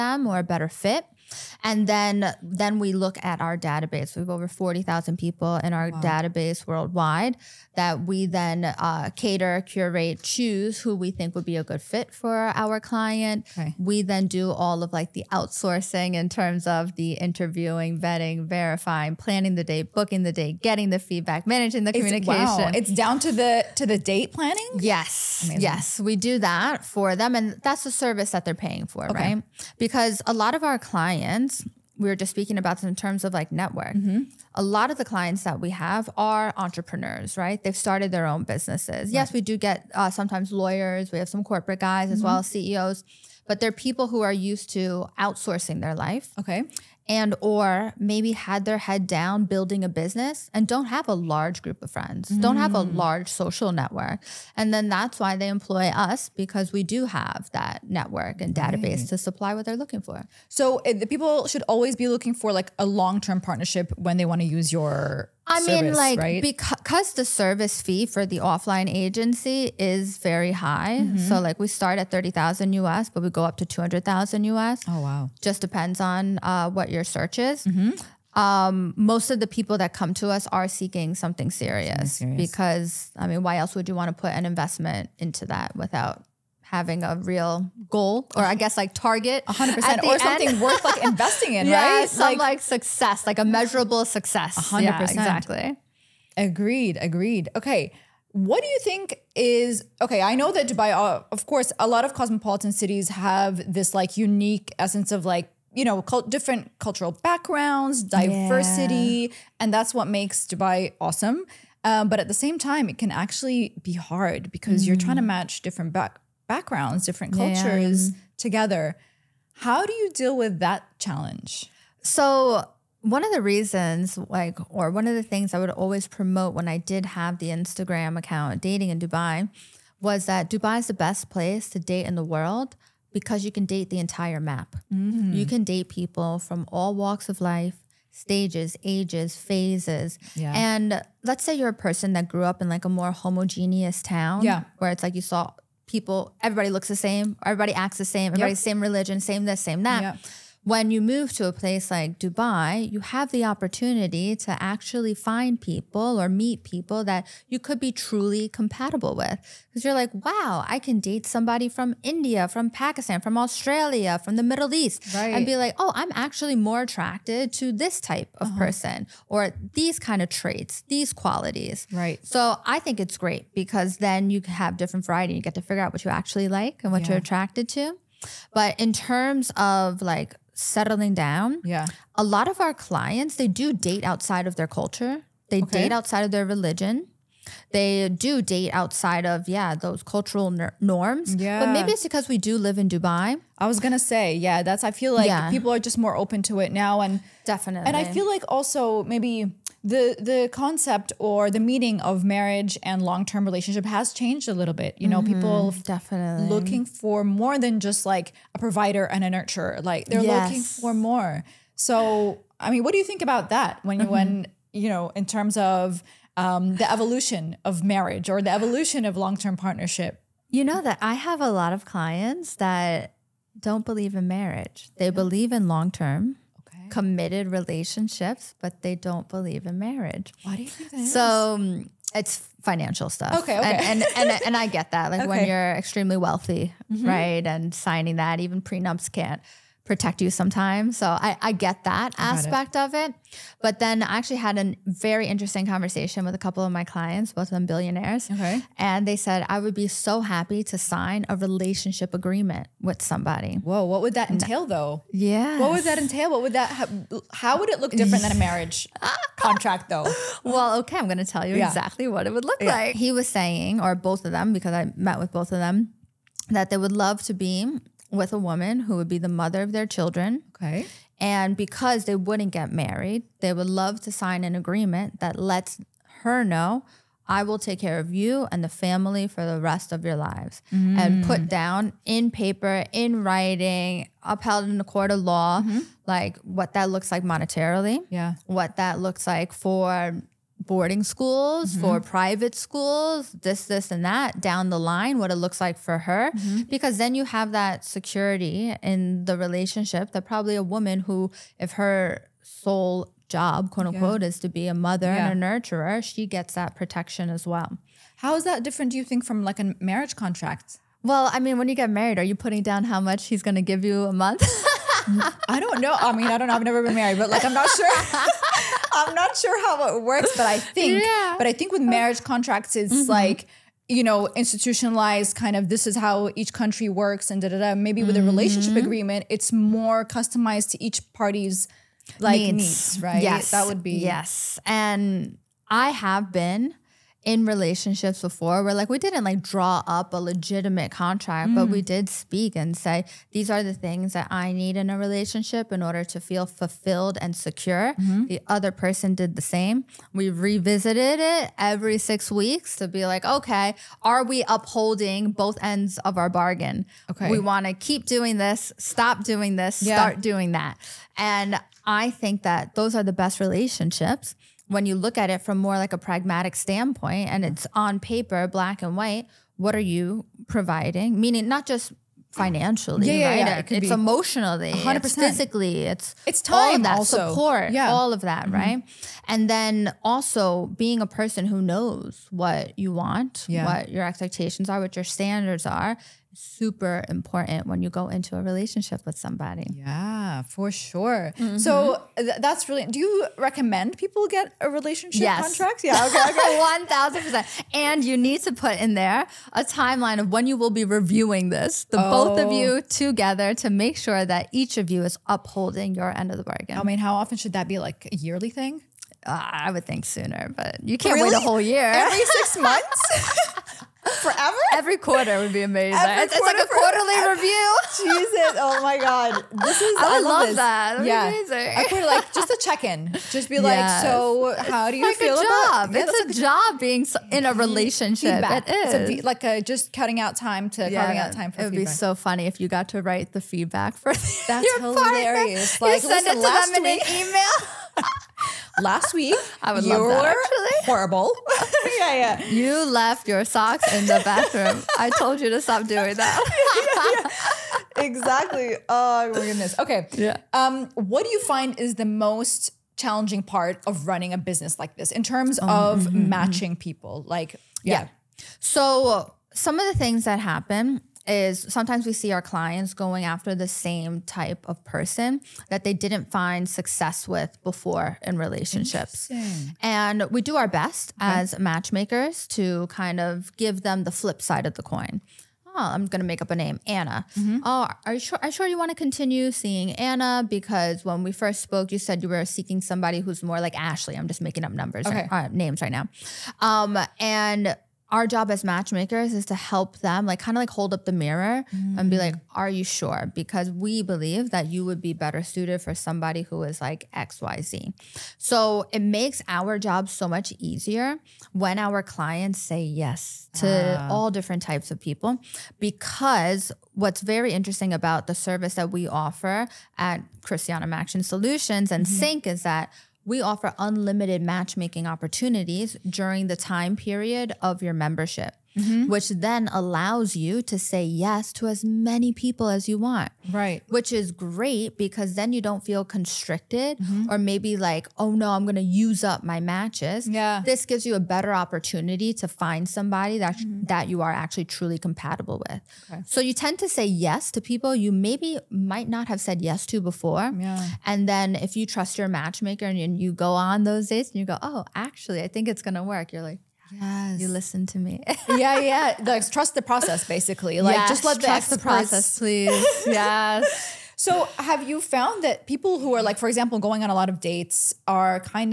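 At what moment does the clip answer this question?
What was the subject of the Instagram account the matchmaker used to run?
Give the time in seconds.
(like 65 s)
128 s.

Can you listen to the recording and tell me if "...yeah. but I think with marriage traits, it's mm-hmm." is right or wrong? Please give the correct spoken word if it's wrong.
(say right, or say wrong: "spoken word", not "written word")
wrong: "contracts", not "traits".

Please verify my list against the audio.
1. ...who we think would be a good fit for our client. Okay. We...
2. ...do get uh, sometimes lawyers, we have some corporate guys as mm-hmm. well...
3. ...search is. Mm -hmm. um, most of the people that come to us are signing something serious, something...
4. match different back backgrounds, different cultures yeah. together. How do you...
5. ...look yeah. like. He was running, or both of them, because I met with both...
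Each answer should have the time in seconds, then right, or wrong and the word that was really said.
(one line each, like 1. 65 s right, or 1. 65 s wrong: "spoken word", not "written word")
1. 10 s right
2. 39 s right
3. 77 s wrong: "seeking", not "signing"
4. 115 s right
5. 262 s wrong: "saying", not "running".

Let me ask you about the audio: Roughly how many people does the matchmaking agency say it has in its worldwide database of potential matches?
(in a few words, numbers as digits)
Over 40,000.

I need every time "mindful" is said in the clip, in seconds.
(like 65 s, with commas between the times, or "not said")
not said.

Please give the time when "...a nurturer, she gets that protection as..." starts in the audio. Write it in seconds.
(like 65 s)
305 s.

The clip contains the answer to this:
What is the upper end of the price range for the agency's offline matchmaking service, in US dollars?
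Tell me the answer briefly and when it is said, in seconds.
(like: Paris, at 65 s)
$200,000, at 73 s.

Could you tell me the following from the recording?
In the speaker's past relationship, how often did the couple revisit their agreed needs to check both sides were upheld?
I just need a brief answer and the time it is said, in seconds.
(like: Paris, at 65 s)
Every 6 weeks, at 351 s.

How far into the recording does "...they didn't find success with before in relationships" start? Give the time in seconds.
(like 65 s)
465 s.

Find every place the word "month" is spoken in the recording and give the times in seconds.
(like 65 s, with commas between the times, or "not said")
314 s, 412 s.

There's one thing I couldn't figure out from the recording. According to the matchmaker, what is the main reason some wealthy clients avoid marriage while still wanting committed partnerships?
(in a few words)
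Financial stuff.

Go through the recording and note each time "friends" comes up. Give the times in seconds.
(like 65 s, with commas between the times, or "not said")
51 s.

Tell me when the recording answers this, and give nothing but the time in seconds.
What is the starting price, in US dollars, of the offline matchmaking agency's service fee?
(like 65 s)
72 s.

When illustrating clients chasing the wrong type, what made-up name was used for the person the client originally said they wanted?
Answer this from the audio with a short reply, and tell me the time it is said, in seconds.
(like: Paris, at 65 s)
Ashley, at 483 s.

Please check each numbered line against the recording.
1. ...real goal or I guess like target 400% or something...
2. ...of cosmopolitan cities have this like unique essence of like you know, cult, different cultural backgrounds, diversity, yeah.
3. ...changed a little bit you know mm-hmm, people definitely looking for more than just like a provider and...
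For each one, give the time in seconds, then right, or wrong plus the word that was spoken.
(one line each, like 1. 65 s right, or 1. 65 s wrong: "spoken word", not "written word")
1. 87 s wrong: "100", not "400"
2. 102 s right
3. 204 s right.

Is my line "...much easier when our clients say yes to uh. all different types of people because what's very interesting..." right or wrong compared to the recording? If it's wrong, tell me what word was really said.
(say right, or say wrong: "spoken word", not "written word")
right.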